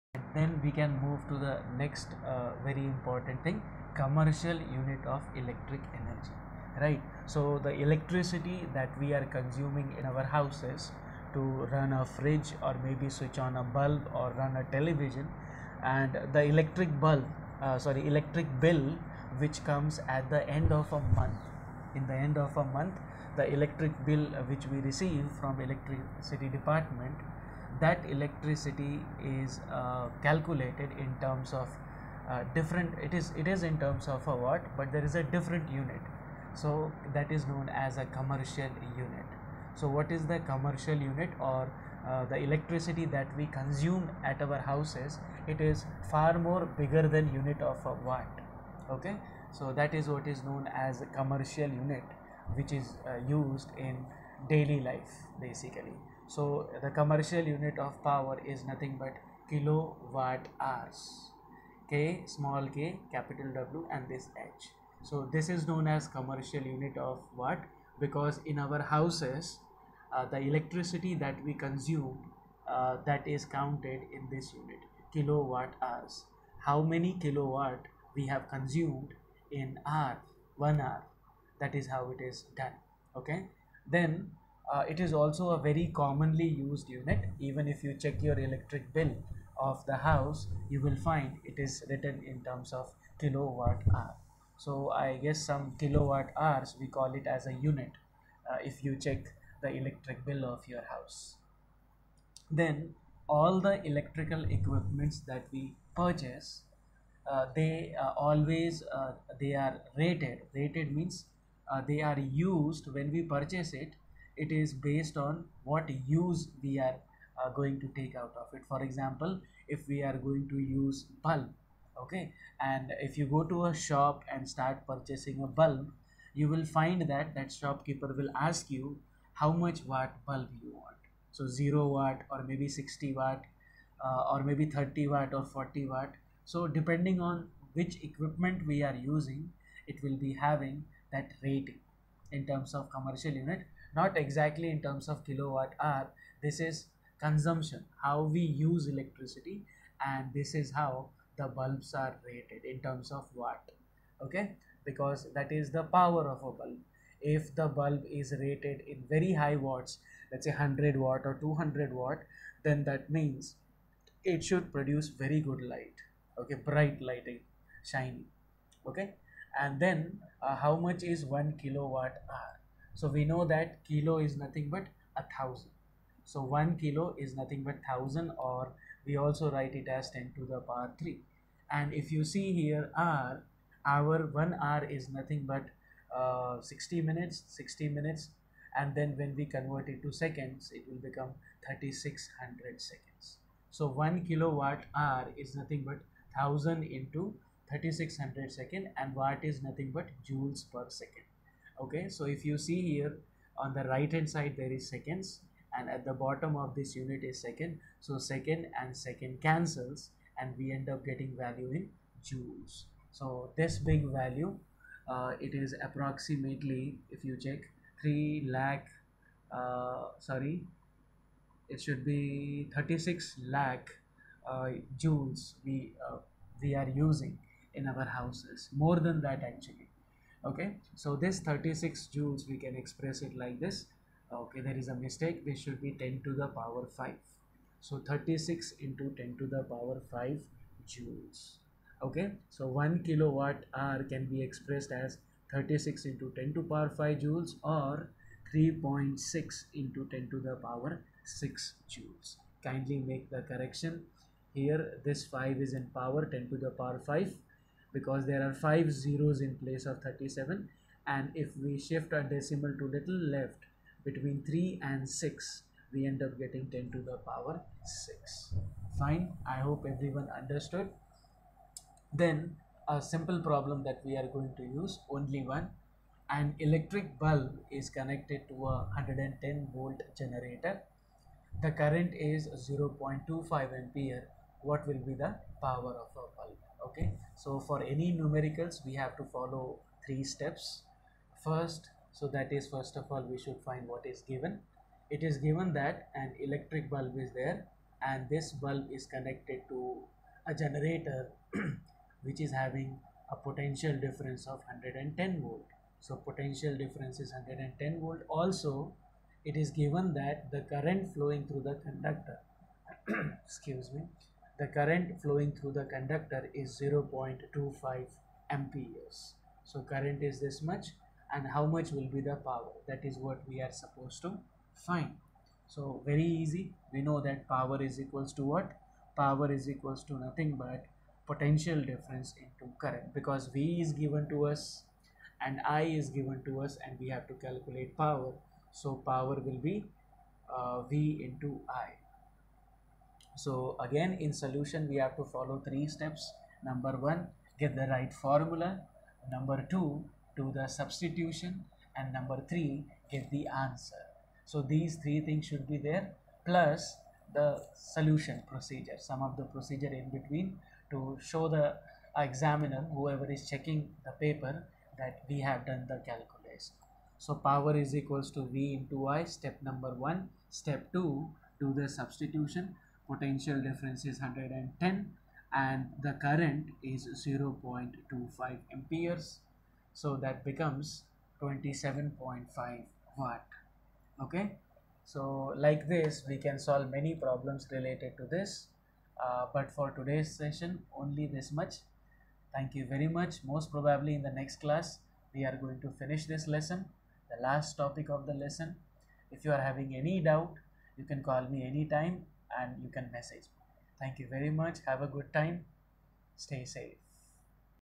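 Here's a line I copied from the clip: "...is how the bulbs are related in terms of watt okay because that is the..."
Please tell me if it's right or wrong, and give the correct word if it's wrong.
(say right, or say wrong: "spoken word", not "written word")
wrong: "rated", not "related".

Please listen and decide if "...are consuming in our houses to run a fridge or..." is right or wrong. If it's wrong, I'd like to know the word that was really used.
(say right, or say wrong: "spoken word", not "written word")
right.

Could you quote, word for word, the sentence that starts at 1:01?
K small k capital W and this H.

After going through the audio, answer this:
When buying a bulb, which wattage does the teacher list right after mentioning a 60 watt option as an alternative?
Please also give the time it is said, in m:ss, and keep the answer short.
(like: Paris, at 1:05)
30 watt, at 2:14.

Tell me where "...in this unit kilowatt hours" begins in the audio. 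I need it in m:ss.
1:14.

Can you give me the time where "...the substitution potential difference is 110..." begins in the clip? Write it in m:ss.
6:11.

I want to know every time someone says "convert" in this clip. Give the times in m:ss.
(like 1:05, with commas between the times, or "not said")
3:09.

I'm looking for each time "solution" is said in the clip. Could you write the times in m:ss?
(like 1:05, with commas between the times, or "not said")
5:44, 5:57.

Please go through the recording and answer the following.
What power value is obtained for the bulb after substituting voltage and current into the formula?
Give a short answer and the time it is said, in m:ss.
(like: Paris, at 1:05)
27.5 watt, at 6:21.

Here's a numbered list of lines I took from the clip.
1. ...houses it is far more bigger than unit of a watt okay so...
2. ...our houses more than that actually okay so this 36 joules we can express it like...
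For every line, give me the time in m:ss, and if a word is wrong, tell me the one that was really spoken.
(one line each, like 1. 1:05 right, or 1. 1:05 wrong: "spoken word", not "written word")
1. 0:44 right
2. 3:47 right.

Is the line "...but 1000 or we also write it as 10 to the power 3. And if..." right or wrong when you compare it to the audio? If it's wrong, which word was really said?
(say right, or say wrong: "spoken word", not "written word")
right.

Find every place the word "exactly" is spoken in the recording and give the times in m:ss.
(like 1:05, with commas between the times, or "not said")
2:24.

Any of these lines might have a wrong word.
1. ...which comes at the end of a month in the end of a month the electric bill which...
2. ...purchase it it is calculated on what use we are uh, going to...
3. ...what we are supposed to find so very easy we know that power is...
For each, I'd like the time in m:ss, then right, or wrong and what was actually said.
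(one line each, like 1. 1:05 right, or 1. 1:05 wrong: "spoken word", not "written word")
1. 0:19 right
2. 1:53 wrong: "based", not "calculated"
3. 5:23 right.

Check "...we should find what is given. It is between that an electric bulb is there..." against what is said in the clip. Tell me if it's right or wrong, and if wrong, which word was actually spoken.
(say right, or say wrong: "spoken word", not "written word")
wrong: "given", not "between".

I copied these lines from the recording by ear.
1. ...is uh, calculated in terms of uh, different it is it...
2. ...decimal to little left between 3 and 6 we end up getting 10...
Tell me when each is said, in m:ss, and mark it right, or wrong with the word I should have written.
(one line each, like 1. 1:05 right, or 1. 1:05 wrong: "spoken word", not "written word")
1. 0:29 right
2. 4:22 right.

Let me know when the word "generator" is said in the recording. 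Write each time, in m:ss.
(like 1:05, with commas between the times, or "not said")
4:40, 5:00.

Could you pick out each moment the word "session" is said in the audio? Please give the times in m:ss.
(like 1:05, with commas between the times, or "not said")
6:30.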